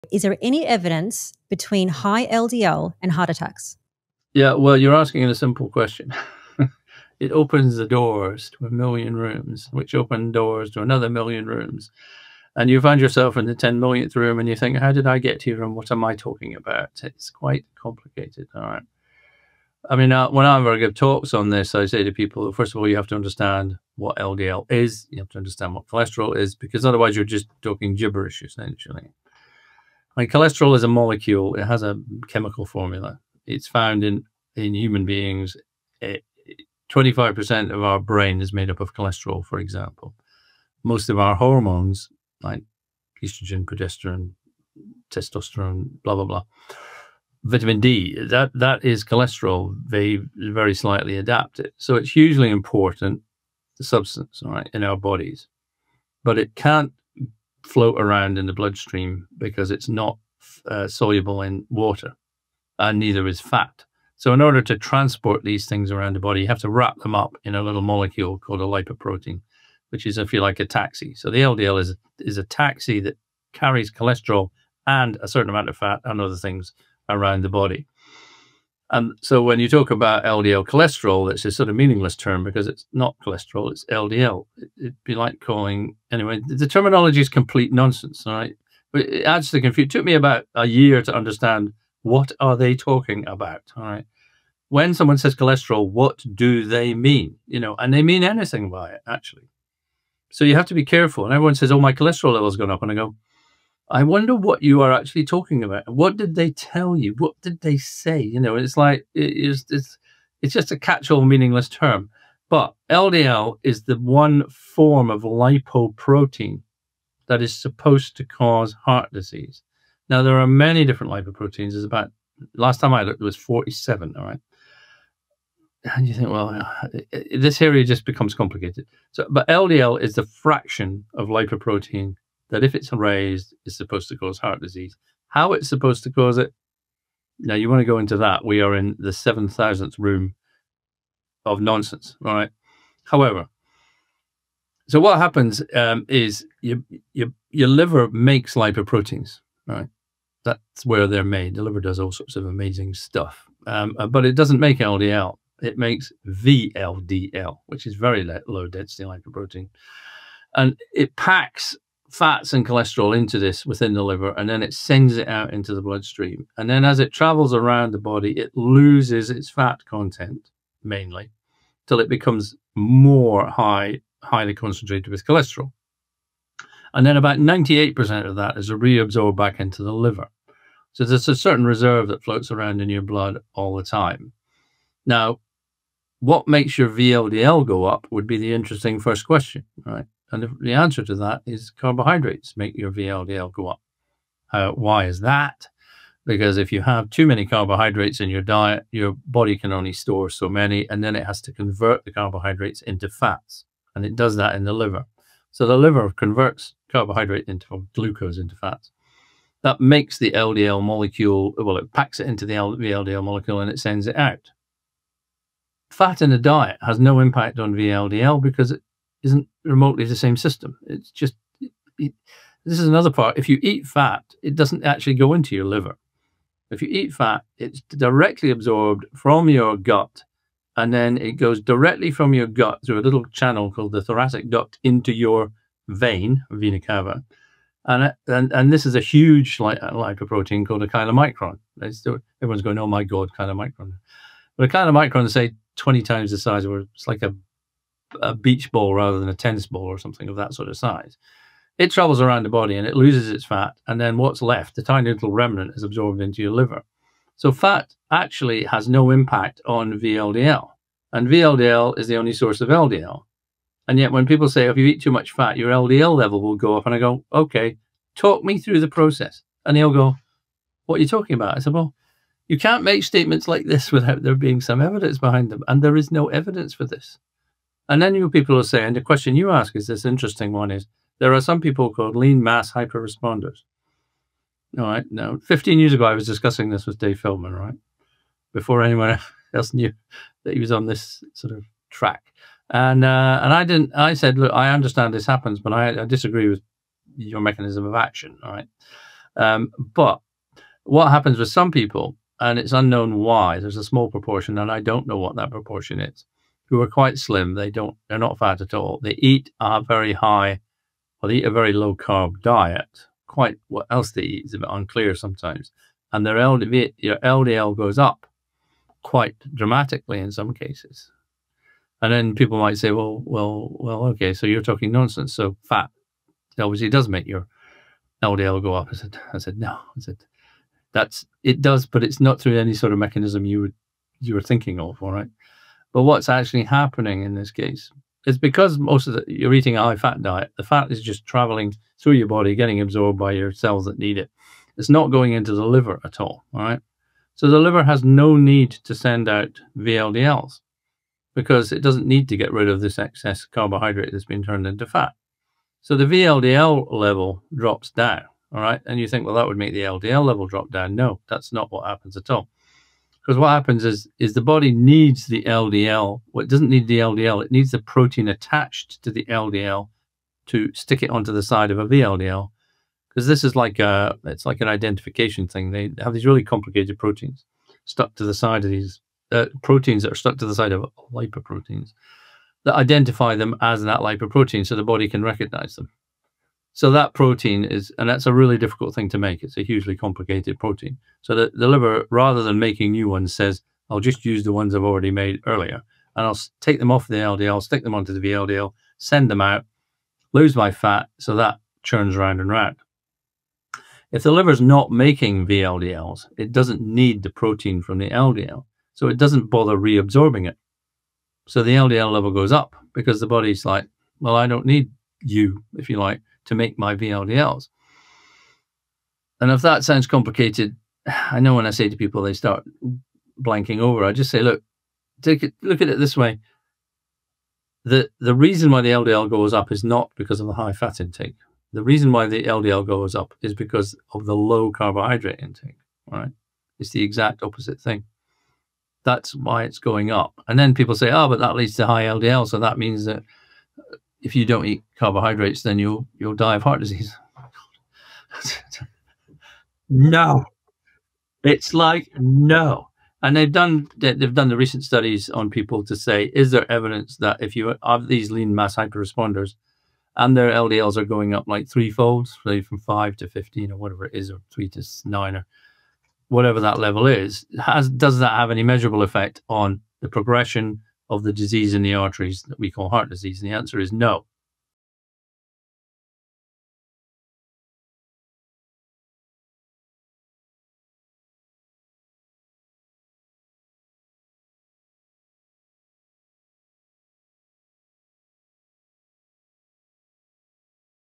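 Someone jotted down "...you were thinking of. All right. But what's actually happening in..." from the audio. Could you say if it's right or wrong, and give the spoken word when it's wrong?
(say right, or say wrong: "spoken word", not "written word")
right.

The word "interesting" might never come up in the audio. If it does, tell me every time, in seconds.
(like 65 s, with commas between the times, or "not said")
188 s, 280 s.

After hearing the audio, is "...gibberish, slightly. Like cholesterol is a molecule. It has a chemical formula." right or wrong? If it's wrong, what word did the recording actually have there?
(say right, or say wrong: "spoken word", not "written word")
wrong: "essentially", not "slightly".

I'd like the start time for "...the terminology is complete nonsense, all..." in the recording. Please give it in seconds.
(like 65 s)
86 s.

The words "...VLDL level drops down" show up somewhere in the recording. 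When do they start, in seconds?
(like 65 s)
356 s.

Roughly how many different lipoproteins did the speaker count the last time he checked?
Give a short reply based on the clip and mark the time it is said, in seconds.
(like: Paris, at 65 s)
47, at 123 s.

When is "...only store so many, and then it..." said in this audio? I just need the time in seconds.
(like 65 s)
199 s.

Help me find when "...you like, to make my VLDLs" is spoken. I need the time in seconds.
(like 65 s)
415 s.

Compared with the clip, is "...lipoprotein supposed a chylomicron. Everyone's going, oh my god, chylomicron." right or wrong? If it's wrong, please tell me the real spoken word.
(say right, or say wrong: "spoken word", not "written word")
wrong: "called", not "supposed".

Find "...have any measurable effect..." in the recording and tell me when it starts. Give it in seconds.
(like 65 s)
468 s.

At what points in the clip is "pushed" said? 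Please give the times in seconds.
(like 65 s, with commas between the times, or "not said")
not said.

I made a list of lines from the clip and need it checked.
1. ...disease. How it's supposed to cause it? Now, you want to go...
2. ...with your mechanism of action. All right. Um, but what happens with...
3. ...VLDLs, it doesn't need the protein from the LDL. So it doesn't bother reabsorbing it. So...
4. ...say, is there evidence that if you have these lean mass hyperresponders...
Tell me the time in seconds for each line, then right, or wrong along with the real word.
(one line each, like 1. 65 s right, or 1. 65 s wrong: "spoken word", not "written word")
1. 134 s right
2. 296 s right
3. 405 s right
4. 455 s right.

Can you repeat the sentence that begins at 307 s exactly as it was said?
They don't, they're not fat at all.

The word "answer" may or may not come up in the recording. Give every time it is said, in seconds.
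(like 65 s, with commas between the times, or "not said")
190 s, 473 s.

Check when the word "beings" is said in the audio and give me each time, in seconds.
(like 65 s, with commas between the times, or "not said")
35 s, 274 s.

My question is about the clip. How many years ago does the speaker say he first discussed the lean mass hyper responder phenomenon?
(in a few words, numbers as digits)
15.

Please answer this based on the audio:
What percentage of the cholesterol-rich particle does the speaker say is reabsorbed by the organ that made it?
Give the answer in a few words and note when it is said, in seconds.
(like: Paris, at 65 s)
98%, at 177 s.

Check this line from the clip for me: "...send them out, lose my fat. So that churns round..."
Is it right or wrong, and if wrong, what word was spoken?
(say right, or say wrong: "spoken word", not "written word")
right.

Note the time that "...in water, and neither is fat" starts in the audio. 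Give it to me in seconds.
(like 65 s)
61 s.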